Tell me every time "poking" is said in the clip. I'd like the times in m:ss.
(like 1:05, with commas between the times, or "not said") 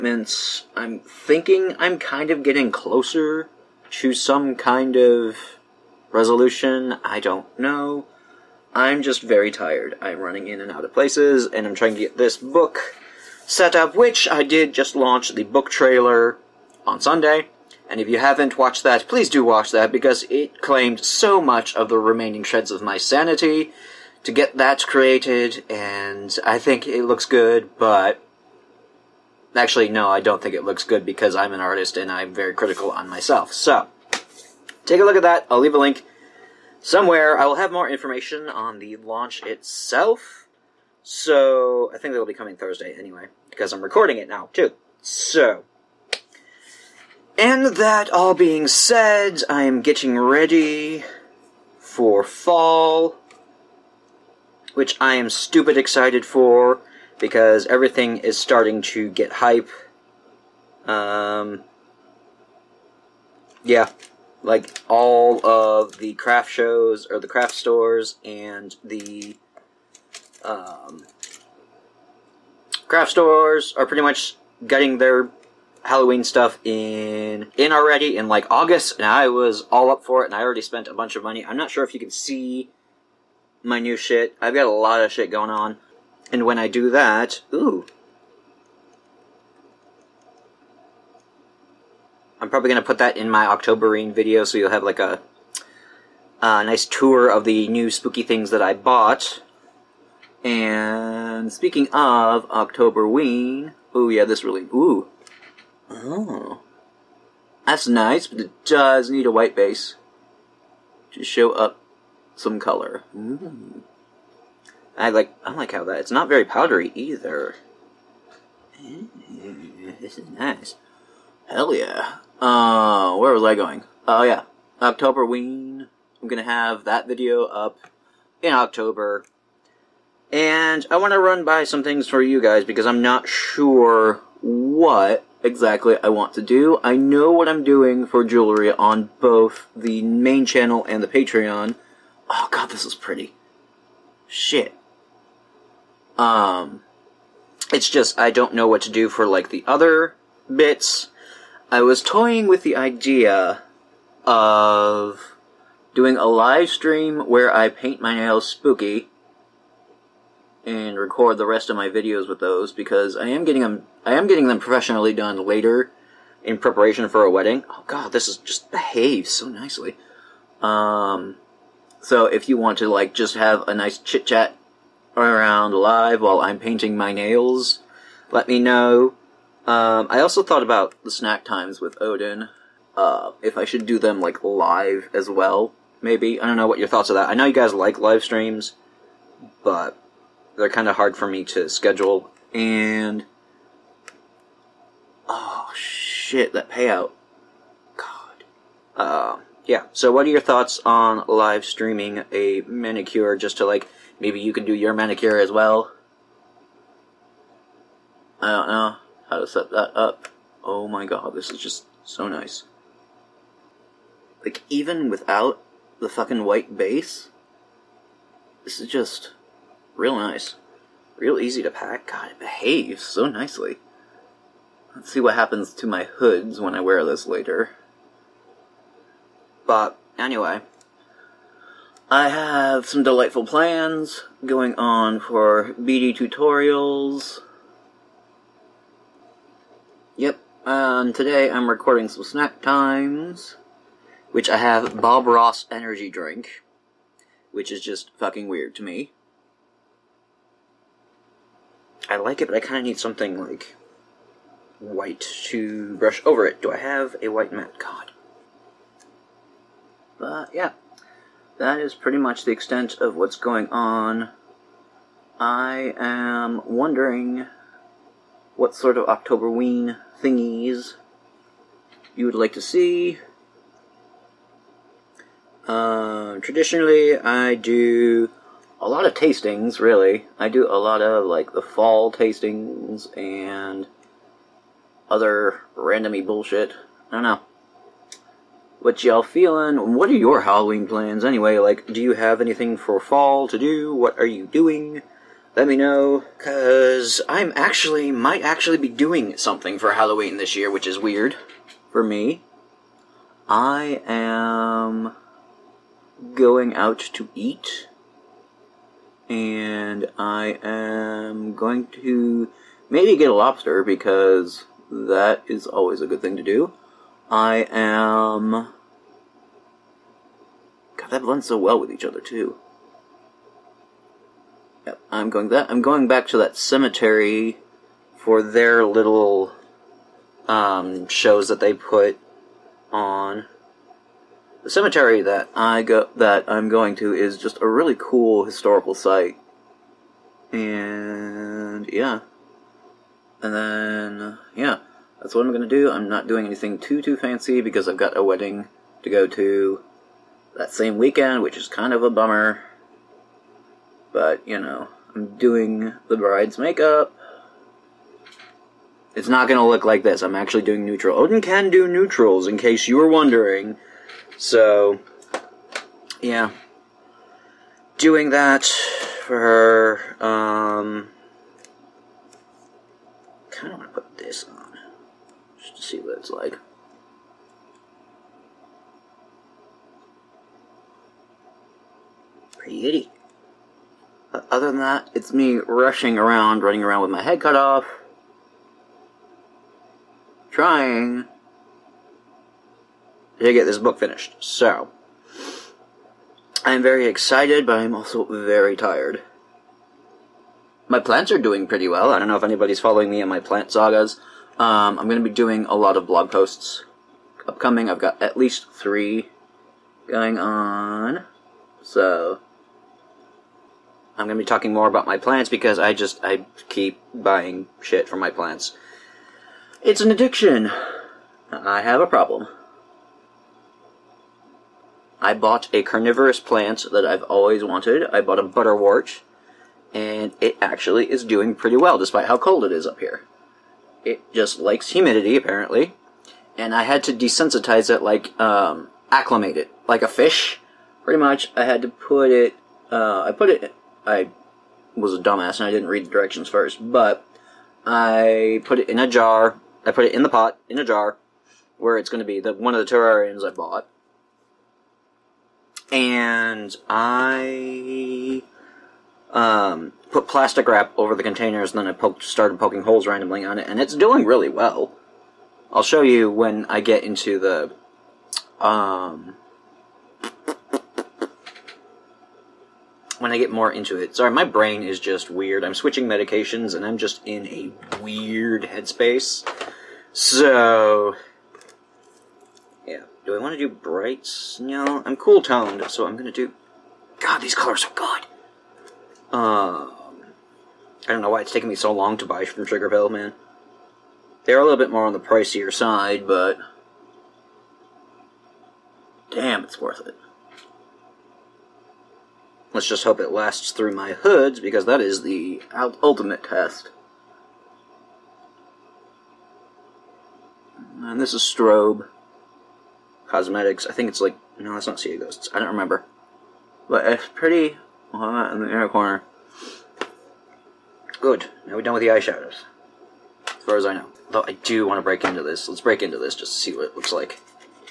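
7:42.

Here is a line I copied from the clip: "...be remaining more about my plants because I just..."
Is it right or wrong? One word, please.
wrong.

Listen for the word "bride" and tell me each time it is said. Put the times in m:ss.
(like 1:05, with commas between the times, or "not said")
5:56.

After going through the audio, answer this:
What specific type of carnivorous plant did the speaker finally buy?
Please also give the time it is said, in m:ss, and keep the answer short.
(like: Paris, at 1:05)
butterwort, at 7:08.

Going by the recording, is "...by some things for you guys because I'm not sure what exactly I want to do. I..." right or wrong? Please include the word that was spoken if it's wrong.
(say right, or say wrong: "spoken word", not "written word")
right.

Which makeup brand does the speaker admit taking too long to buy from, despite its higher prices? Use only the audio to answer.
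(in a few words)
Sugarpill.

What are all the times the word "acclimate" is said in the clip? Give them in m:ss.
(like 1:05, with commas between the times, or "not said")
7:19.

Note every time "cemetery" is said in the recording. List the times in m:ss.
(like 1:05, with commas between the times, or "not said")
5:26, 5:34.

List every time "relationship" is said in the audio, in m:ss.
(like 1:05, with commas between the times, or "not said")
not said.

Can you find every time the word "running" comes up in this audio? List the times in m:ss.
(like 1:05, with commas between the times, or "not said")
0:10, 6:26.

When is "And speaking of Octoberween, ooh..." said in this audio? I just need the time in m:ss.
1:40.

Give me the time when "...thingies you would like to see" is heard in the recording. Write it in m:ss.
4:30.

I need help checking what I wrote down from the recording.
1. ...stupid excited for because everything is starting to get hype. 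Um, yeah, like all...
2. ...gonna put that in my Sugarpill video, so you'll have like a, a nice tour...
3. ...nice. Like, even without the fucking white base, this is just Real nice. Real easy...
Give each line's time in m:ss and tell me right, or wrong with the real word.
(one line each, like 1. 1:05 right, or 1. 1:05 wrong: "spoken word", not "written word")
1. 0:55 right
2. 1:32 wrong: "Octoberween", not "Sugarpill"
3. 3:32 right.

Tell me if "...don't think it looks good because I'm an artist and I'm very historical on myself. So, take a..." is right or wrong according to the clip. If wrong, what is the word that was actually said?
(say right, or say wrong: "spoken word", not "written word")
wrong: "critical", not "historical".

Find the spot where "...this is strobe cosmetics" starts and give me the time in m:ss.
8:31.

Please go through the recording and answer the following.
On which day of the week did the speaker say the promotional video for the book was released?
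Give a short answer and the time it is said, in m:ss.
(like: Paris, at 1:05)
Sunday, at 0:16.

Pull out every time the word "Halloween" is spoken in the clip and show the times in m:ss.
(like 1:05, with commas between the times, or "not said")
1:15, 4:50, 4:59.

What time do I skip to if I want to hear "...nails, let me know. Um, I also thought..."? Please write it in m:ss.
2:57.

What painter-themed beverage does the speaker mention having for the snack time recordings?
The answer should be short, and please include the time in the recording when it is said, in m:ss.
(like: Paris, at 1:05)
Bob Ross energy drink, at 4:04.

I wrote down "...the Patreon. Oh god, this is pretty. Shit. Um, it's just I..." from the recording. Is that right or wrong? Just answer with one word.
right.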